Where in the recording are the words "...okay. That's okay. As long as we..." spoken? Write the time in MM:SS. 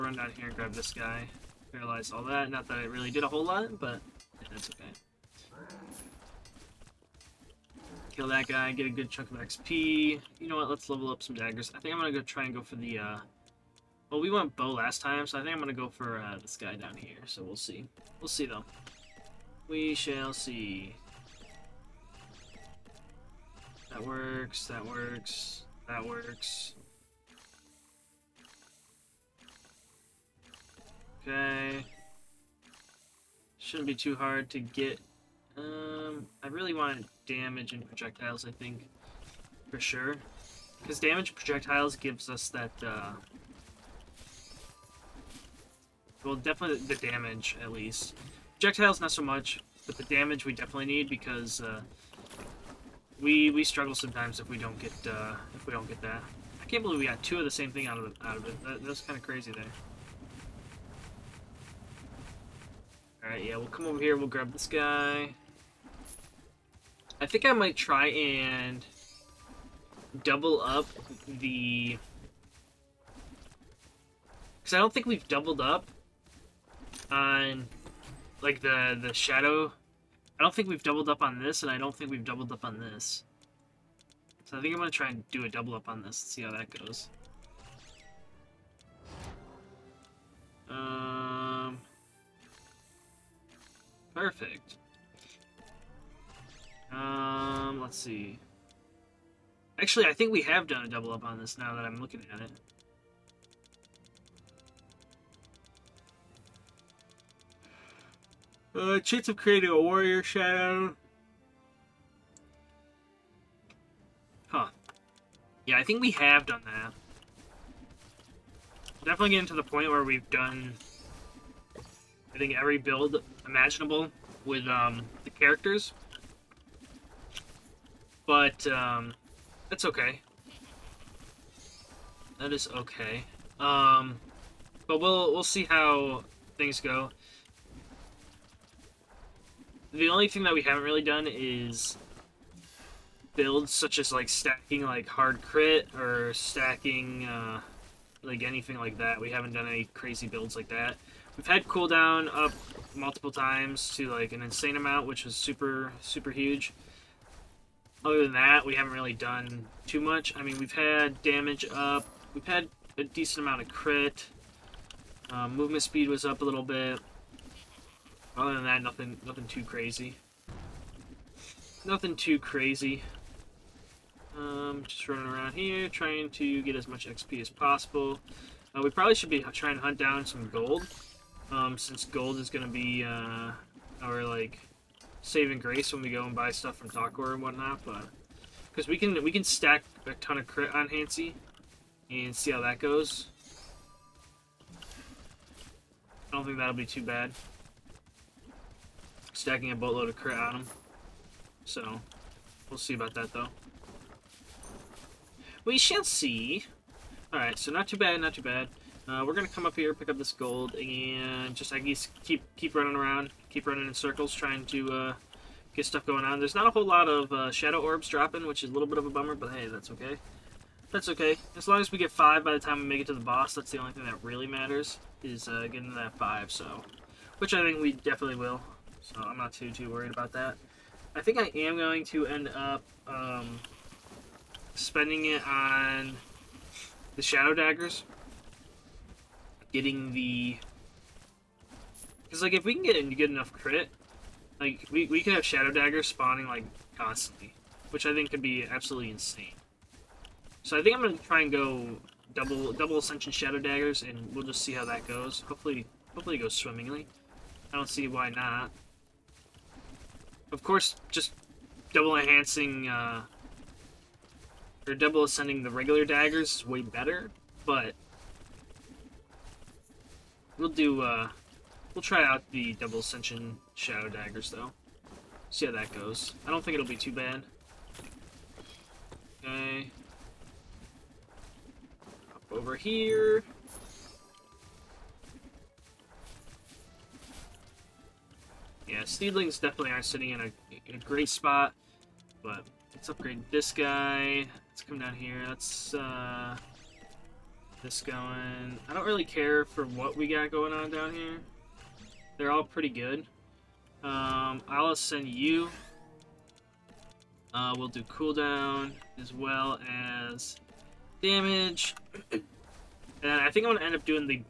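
03:39.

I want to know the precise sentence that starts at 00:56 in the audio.
I can't believe we got two of the same thing out of it.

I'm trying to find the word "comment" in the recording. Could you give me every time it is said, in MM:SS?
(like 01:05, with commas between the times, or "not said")
not said.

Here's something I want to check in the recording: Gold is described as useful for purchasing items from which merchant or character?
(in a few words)
Takor.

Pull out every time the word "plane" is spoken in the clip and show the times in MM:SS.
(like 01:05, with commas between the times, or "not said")
not said.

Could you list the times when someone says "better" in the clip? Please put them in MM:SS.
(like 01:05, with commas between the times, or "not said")
04:26.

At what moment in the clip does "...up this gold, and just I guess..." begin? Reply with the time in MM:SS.
03:30.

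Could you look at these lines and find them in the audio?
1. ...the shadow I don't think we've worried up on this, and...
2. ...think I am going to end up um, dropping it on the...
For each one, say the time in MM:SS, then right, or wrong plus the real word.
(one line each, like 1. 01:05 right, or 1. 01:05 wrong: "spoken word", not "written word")
1. 01:19 wrong: "doubled", not "worried"
2. 03:51 wrong: "spending", not "dropping".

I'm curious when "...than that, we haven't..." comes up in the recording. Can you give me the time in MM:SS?
02:38.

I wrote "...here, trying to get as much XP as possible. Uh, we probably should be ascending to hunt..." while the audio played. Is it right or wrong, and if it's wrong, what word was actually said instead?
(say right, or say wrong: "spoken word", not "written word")
wrong: "trying", not "ascending".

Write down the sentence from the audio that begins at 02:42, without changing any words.
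We've had a decent amount of crit.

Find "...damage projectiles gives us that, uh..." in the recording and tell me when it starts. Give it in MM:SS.
00:41.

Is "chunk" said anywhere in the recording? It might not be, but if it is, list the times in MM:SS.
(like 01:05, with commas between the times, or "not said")
00:09.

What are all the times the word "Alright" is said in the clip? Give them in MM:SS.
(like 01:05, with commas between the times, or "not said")
03:27.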